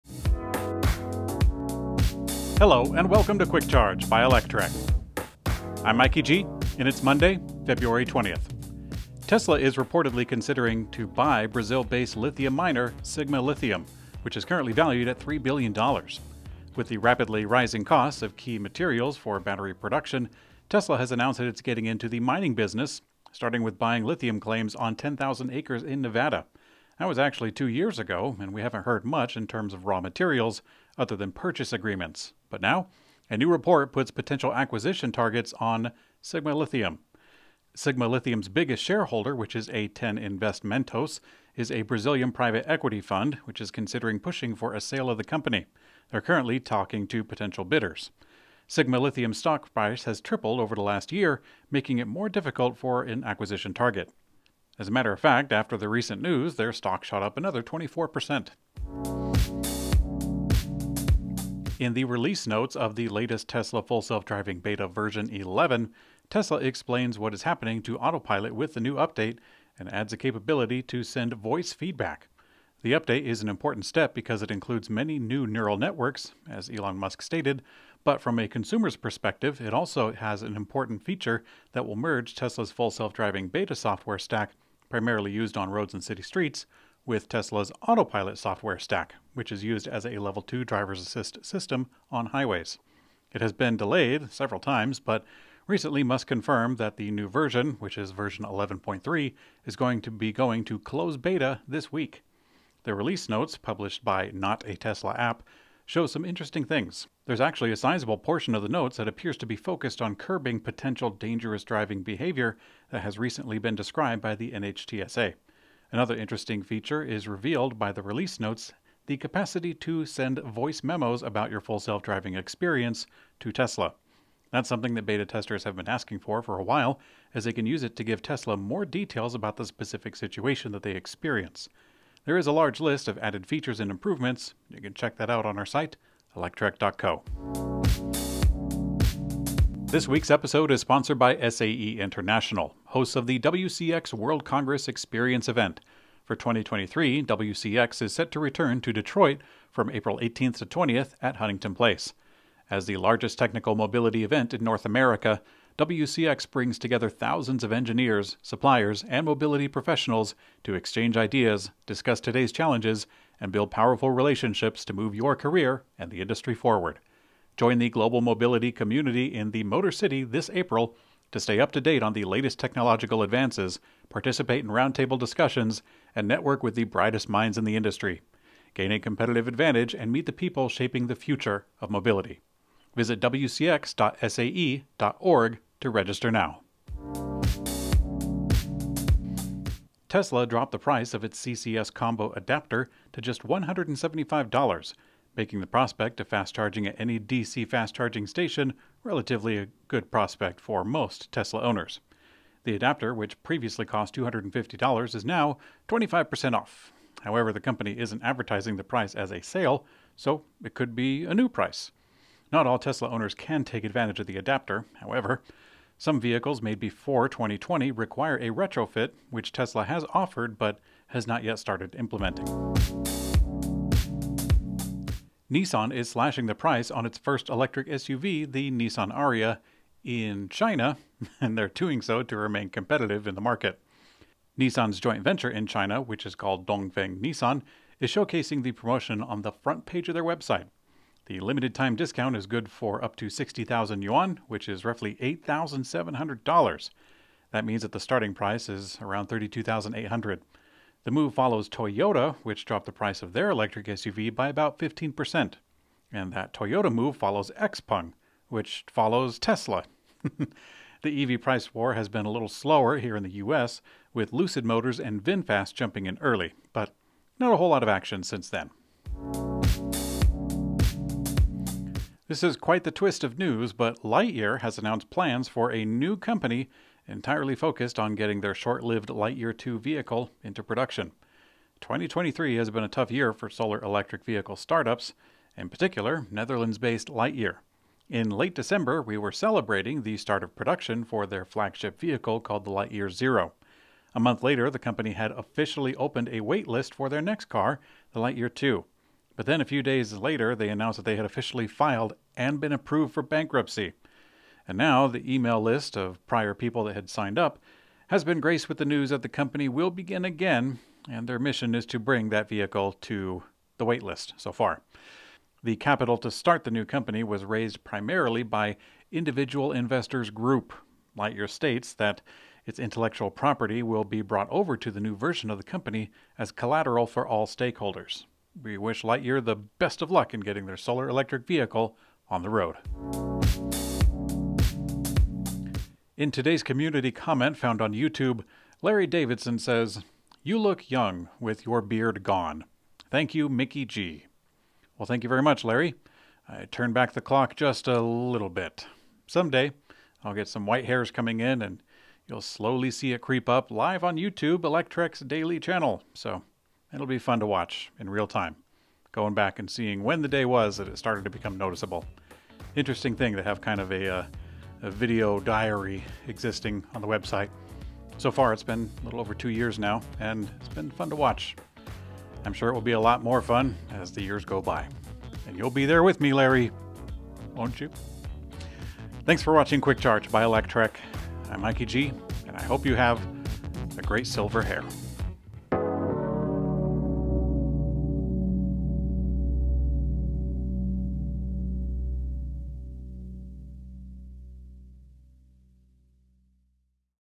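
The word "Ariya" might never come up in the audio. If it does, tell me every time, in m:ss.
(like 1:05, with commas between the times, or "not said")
3:49.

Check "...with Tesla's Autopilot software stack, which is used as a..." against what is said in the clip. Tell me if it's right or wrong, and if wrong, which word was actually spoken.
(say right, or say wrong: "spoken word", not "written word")
right.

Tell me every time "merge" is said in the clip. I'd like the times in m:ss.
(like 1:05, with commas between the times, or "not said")
1:21.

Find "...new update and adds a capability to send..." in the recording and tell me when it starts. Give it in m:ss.
1:08.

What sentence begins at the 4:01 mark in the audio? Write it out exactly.
The limited time discount is good for up to 60,000 yuan, which is roughly $8,700.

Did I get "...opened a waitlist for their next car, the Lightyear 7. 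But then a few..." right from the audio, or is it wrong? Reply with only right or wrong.
wrong.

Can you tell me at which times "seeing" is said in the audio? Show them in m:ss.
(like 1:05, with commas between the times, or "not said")
5:59.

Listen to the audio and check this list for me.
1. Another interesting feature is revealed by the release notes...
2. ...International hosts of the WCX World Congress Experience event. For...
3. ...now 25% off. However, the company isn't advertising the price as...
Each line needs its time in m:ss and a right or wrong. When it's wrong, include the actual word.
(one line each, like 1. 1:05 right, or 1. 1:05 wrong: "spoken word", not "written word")
1. 1:55 right
2. 2:21 right
3. 3:25 right.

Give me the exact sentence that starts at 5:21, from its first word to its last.
Lightyear states that its intellectual property will be brought over to the new version of the company as collateral for all stakeholders.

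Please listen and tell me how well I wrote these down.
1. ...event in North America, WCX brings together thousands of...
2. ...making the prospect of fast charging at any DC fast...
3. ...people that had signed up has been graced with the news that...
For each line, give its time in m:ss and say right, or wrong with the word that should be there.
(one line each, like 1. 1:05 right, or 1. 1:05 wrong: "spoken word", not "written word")
1. 2:34 right
2. 3:15 right
3. 5:06 right.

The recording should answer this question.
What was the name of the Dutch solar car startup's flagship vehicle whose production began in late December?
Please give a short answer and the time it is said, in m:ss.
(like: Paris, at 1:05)
Lightyear Zero, at 4:52.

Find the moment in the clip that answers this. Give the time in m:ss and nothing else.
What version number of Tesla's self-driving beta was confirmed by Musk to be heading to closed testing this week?
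1:38.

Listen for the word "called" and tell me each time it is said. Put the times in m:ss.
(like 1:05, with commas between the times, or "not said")
3:56, 4:52.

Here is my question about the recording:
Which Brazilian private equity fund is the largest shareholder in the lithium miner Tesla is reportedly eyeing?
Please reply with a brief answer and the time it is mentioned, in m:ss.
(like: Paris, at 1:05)
A10 Investimentos, at 0:39.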